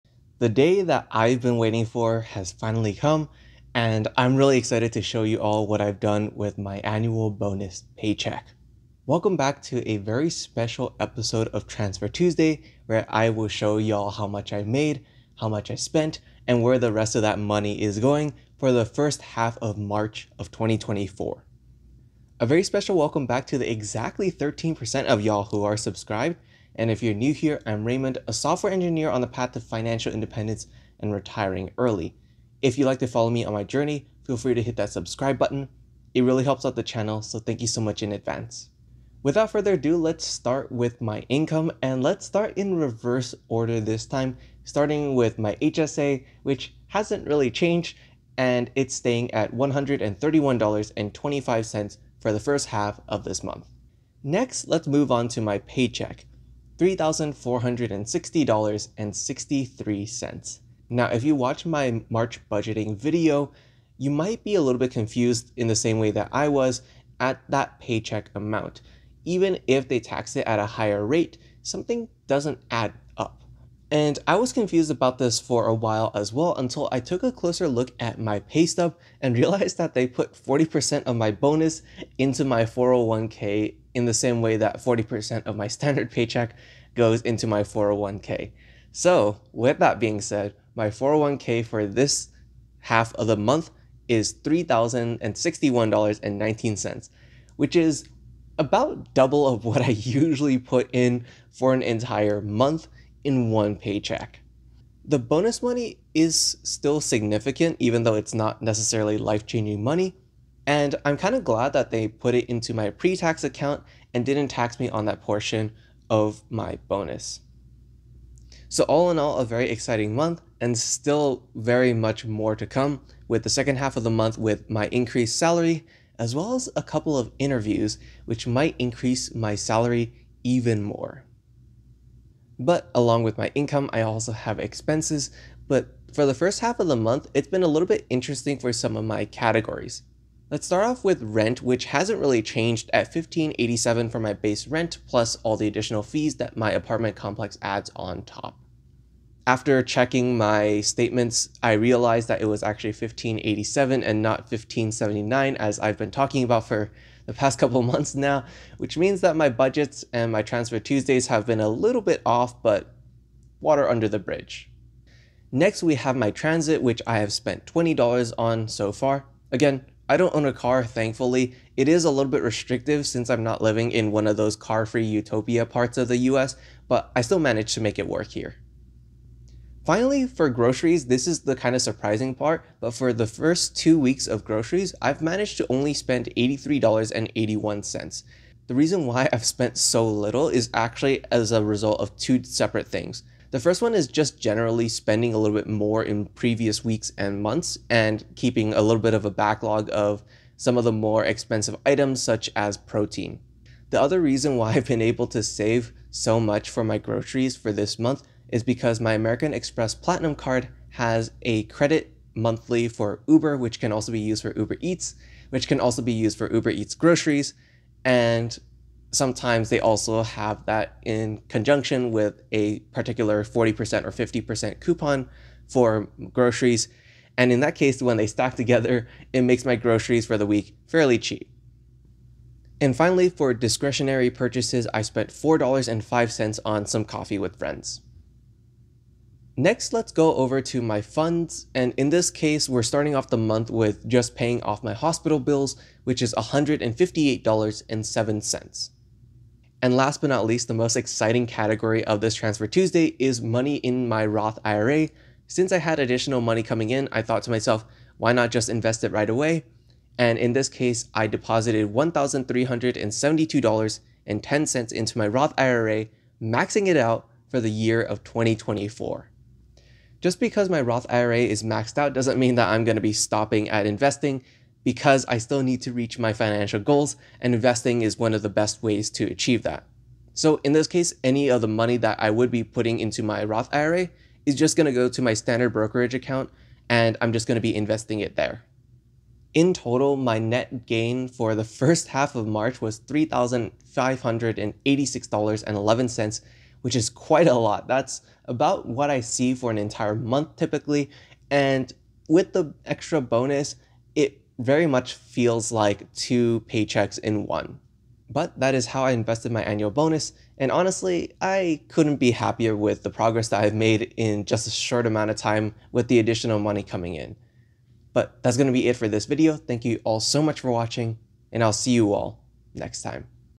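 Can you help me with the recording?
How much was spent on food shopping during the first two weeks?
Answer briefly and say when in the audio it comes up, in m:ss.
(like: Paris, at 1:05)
$83.81, at 3:06.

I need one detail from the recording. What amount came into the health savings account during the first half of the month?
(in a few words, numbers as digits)
$131.25.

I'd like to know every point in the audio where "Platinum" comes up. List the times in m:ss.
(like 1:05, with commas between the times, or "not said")
3:29.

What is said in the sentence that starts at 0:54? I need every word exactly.
Next, let's move on to my paycheck.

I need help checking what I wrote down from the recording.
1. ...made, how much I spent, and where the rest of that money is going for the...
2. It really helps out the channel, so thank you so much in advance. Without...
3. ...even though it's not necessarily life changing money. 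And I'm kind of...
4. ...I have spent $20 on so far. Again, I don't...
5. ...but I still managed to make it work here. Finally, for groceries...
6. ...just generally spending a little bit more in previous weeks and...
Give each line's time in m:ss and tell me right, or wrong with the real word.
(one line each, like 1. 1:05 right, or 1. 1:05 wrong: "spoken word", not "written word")
1. 0:14 right
2. 0:36 right
3. 1:47 right
4. 2:47 right
5. 2:56 right
6. 3:14 right.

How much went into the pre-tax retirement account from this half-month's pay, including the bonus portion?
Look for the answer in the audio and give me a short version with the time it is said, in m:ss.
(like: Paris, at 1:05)
$3,061.19, at 1:34.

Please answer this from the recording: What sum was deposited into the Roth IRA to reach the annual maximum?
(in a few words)
$1,372.10.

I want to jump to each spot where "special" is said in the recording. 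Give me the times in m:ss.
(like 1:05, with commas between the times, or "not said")
0:10, 0:22.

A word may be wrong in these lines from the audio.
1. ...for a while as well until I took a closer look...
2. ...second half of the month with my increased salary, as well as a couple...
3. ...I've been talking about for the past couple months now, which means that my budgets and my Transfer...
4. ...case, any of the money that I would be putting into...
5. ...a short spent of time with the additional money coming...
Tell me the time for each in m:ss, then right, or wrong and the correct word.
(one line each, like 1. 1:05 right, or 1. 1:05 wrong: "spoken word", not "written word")
1. 1:15 right
2. 2:03 right
3. 2:35 right
4. 4:40 right
5. 5:14 wrong: "amount", not "spent".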